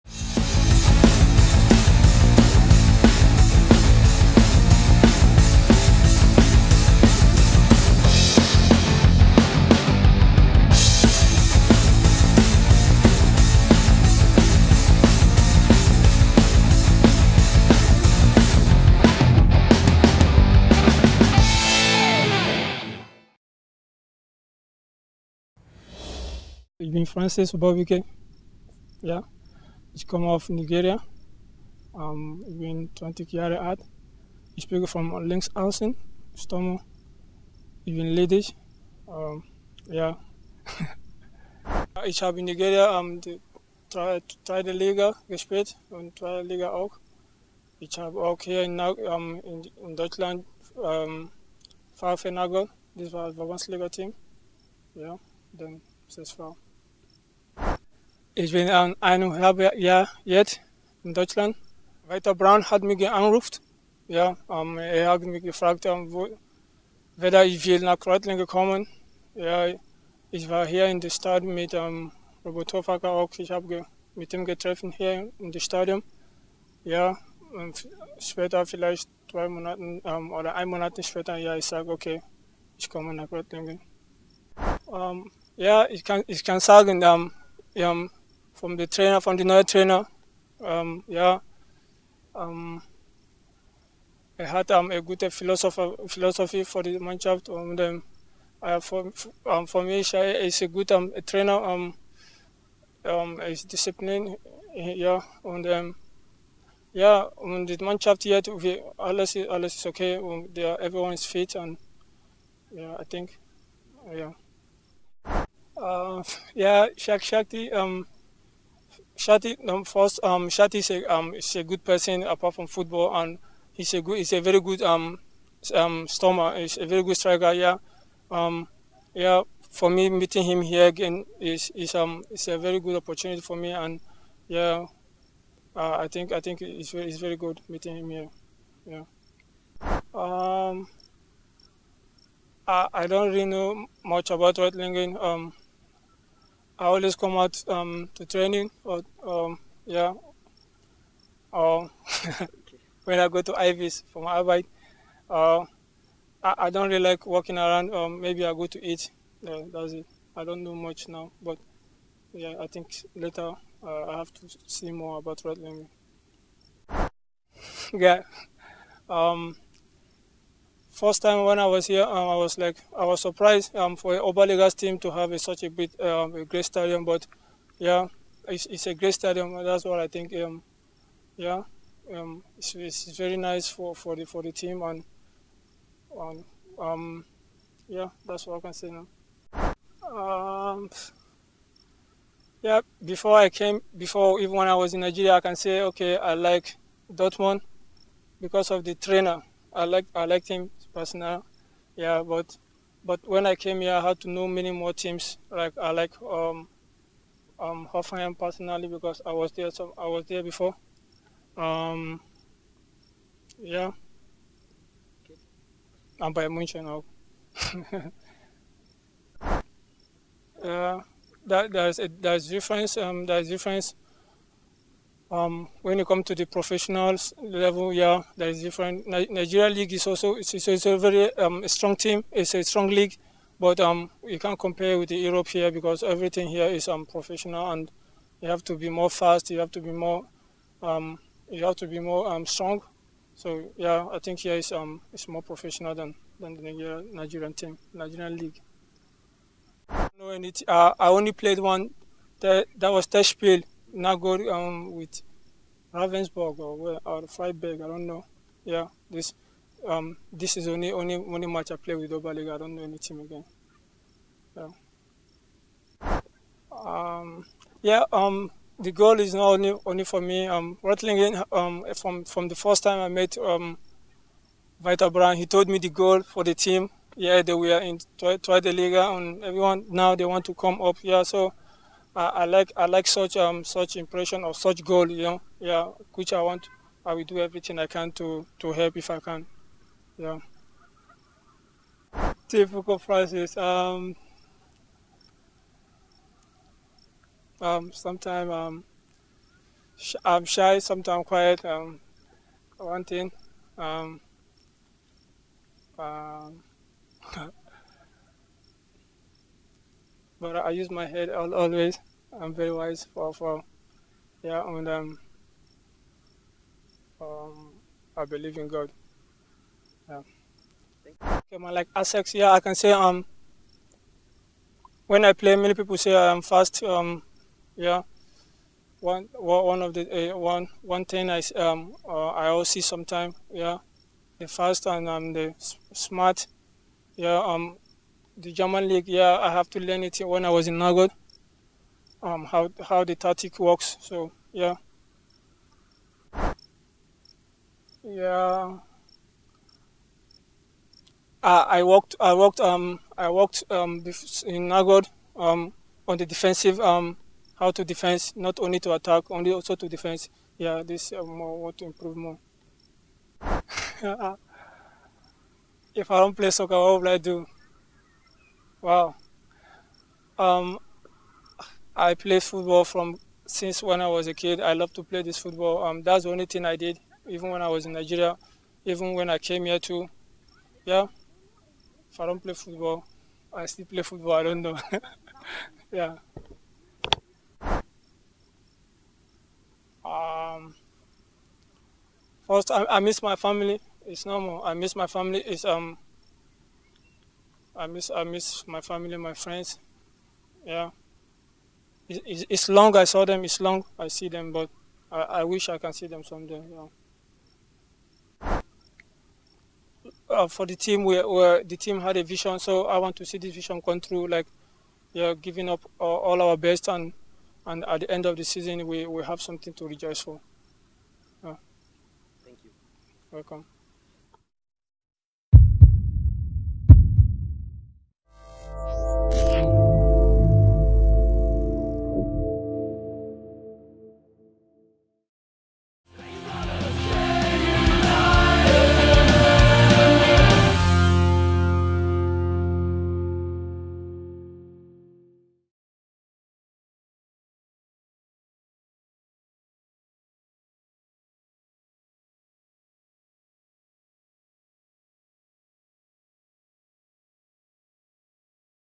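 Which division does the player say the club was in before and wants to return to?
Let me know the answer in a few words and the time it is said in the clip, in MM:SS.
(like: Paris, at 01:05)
Dritte Liga, at 04:38.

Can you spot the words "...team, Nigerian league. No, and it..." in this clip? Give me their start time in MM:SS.
04:07.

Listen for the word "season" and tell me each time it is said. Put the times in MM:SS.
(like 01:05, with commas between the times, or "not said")
06:58.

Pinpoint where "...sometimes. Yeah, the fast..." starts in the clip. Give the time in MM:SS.
05:32.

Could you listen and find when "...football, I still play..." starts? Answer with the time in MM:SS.
06:22.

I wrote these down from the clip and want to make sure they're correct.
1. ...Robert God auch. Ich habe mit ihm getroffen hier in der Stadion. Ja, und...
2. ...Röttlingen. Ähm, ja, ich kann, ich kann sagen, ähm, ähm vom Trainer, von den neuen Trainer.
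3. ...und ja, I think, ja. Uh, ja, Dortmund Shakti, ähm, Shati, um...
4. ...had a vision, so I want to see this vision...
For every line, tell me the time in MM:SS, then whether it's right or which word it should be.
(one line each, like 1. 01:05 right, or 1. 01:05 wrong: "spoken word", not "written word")
1. 01:12 wrong: "Hofacker", not "God"
2. 01:23 right
3. 01:51 wrong: "Shaq", not "Dortmund"
4. 06:52 right.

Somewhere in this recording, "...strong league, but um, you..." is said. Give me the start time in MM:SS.
03:52.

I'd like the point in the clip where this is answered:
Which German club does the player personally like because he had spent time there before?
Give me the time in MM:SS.
03:27.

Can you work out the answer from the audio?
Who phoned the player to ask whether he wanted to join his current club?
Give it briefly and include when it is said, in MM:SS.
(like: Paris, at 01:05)
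Walter Braun, at 01:02.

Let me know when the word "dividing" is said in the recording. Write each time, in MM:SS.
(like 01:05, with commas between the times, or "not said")
not said.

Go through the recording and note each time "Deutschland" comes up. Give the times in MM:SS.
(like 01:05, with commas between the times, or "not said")
00:49, 01:01.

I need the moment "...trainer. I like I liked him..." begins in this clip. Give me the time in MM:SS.
03:18.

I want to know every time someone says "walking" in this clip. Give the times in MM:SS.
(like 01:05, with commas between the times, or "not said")
02:37.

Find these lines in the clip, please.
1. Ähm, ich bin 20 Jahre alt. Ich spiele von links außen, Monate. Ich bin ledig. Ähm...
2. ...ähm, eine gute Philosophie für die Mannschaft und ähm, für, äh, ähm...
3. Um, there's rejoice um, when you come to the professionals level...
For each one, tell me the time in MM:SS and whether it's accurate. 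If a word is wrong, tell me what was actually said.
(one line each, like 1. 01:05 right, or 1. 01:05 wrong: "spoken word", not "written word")
1. 00:31 wrong: "Sturm", not "Monate"
2. 01:34 right
3. 03:42 wrong: "difference", not "rejoice".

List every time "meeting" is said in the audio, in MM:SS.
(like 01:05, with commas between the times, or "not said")
02:10, 02:17.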